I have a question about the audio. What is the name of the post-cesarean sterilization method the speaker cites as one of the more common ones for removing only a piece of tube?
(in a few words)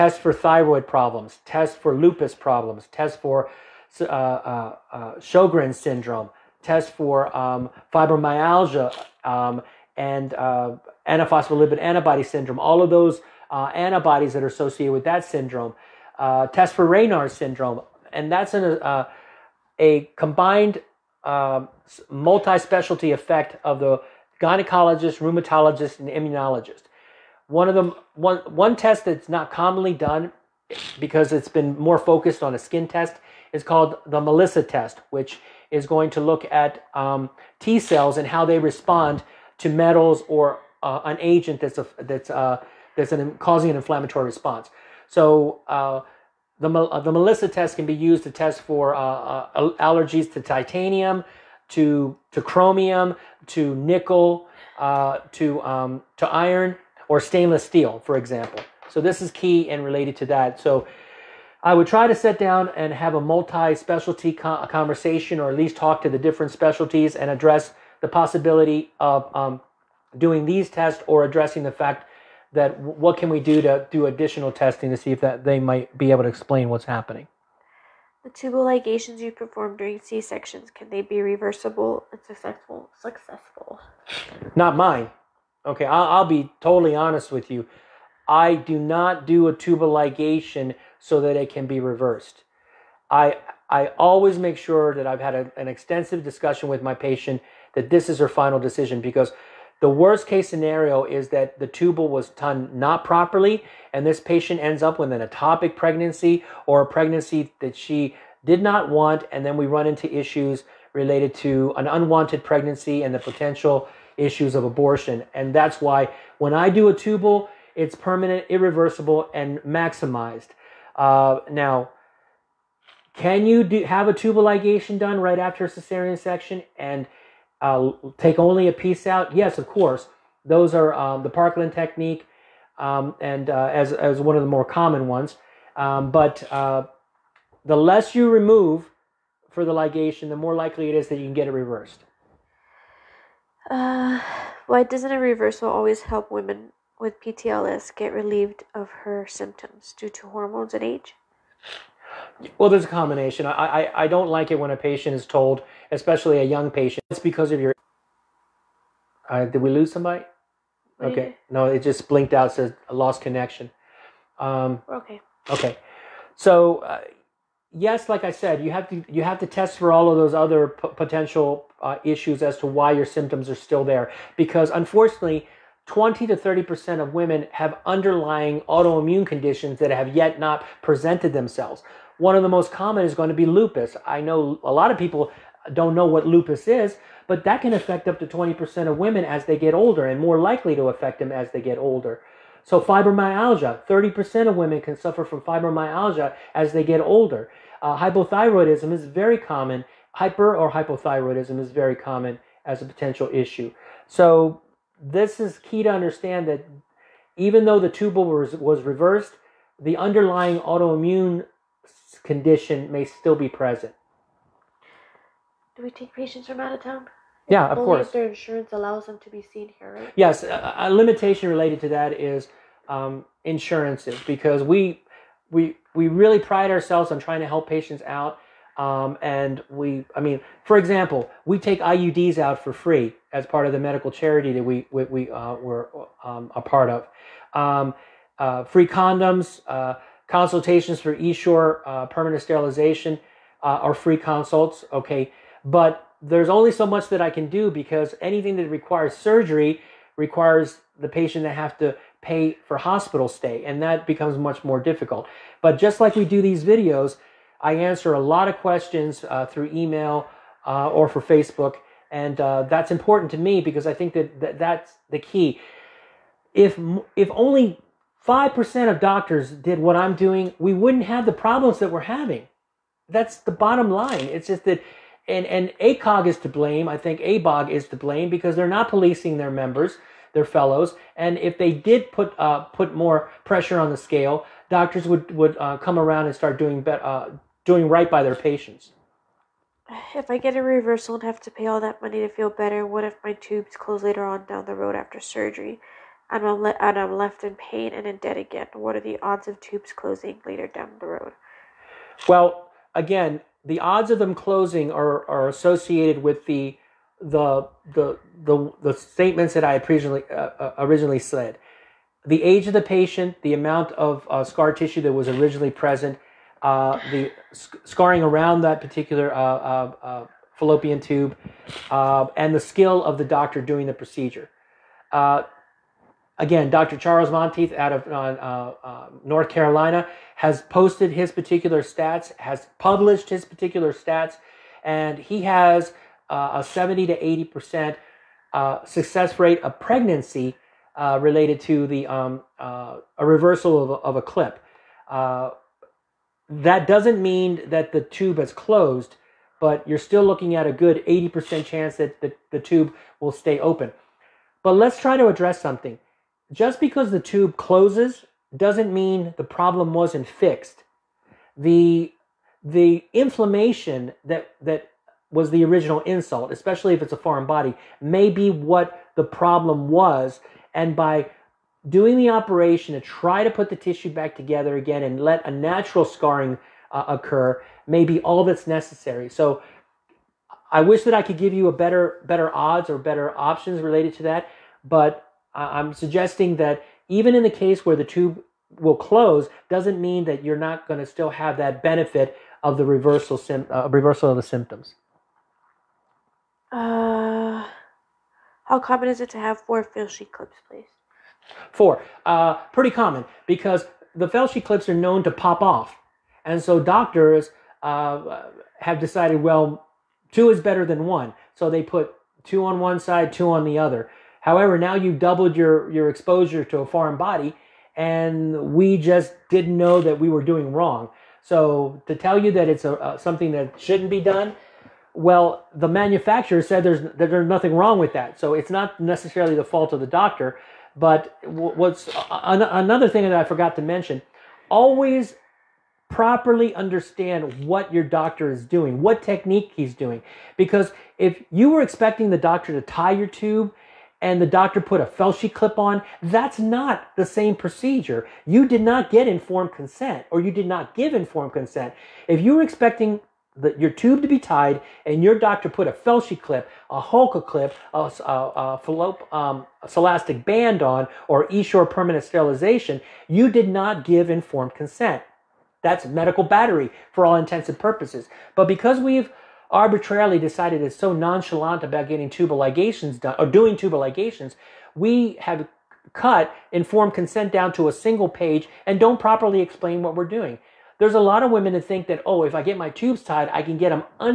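Parkland technique.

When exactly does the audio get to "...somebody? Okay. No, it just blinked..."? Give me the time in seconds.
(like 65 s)
159 s.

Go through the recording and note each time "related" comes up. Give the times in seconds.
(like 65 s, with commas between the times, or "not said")
59 s, 110 s, 221 s, 341 s, 383 s.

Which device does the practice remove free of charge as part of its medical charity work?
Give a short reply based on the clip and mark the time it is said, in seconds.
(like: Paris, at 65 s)
IUDs, at 231 s.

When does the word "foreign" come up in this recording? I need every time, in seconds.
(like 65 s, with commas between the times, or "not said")
367 s, 416 s.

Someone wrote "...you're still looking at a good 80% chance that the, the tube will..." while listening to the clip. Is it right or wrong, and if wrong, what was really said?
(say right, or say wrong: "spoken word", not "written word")
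right.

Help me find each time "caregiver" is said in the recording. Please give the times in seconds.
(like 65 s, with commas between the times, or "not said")
not said.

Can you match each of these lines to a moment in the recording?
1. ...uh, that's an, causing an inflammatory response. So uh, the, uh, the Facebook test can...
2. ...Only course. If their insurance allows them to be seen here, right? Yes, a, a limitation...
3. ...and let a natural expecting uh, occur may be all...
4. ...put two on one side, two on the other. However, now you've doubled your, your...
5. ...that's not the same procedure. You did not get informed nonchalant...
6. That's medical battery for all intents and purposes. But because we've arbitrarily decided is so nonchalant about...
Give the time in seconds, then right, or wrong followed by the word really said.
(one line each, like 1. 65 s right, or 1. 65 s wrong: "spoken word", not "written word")
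1. 42 s wrong: "MELISA", not "Facebook"
2. 217 s right
3. 375 s wrong: "scarring", not "expecting"
4. 411 s right
5. 446 s wrong: "consent", not "nonchalant"
6. 465 s right.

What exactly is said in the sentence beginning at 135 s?
Um, but uh, the less you remove for the ligation, the more likely it is that you can get it reversed.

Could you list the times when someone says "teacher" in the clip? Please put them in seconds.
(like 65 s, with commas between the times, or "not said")
not said.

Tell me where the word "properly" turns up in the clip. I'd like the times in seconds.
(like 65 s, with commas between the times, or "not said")
103 s, 436 s, 479 s.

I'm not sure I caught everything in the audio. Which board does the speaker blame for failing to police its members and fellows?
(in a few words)
ABOG.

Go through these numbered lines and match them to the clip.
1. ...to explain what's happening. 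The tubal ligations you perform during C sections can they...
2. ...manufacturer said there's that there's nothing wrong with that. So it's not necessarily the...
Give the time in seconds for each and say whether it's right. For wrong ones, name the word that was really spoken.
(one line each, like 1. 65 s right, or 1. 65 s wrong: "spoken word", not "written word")
1. 76 s right
2. 425 s right.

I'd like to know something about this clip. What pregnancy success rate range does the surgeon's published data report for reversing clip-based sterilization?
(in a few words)
70 to 80 percent.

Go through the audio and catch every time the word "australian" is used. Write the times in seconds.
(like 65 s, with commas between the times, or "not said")
not said.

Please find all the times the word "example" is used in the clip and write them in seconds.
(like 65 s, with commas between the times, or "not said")
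58 s, 230 s.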